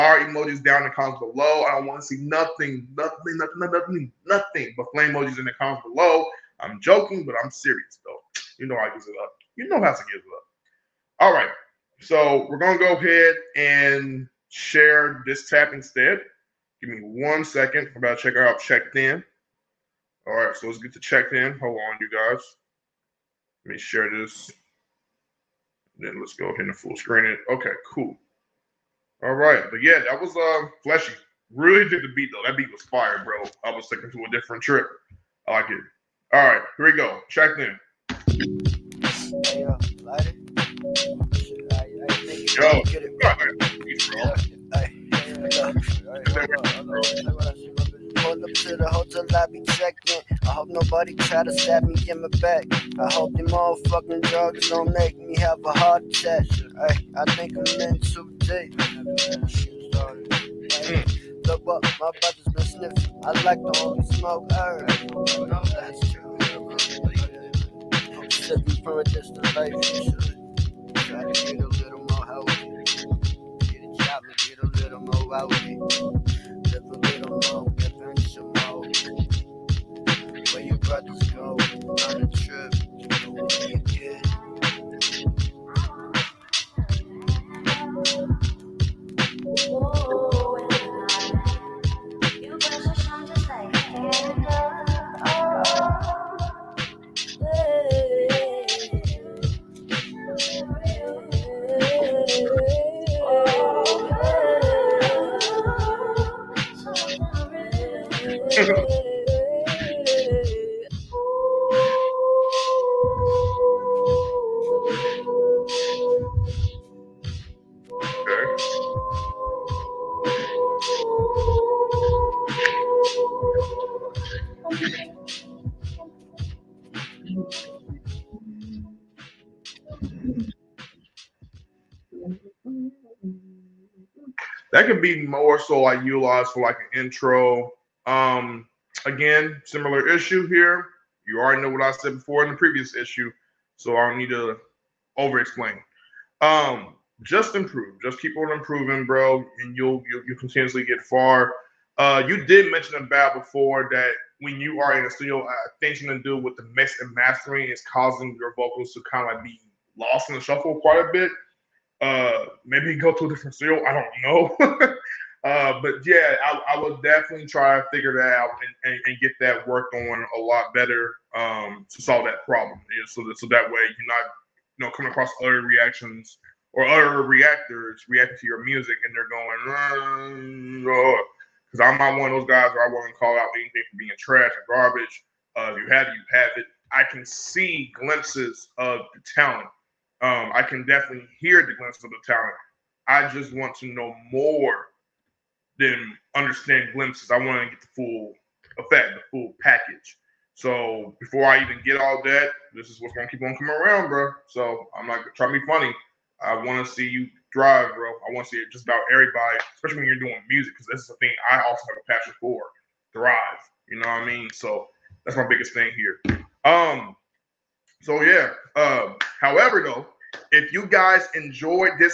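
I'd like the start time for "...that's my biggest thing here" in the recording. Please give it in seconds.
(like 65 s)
215 s.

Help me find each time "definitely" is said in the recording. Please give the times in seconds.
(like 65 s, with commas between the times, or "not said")
166 s, 190 s.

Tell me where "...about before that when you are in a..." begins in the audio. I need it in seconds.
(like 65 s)
152 s.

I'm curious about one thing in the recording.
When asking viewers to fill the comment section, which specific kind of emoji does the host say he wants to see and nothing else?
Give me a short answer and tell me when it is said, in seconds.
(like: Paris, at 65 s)
flame emojis, at 4 s.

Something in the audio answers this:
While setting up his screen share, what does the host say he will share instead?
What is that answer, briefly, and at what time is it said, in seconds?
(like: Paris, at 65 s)
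this tab, at 15 s.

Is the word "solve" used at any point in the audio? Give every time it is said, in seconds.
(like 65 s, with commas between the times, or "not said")
172 s.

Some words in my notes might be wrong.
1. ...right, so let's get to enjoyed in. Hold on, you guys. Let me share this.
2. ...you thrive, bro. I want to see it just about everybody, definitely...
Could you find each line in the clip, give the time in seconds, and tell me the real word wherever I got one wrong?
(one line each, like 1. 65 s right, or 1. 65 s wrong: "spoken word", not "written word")
1. 20 s wrong: "checked", not "enjoyed"
2. 207 s wrong: "especially", not "definitely".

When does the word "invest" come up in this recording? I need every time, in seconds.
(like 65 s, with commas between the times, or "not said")
not said.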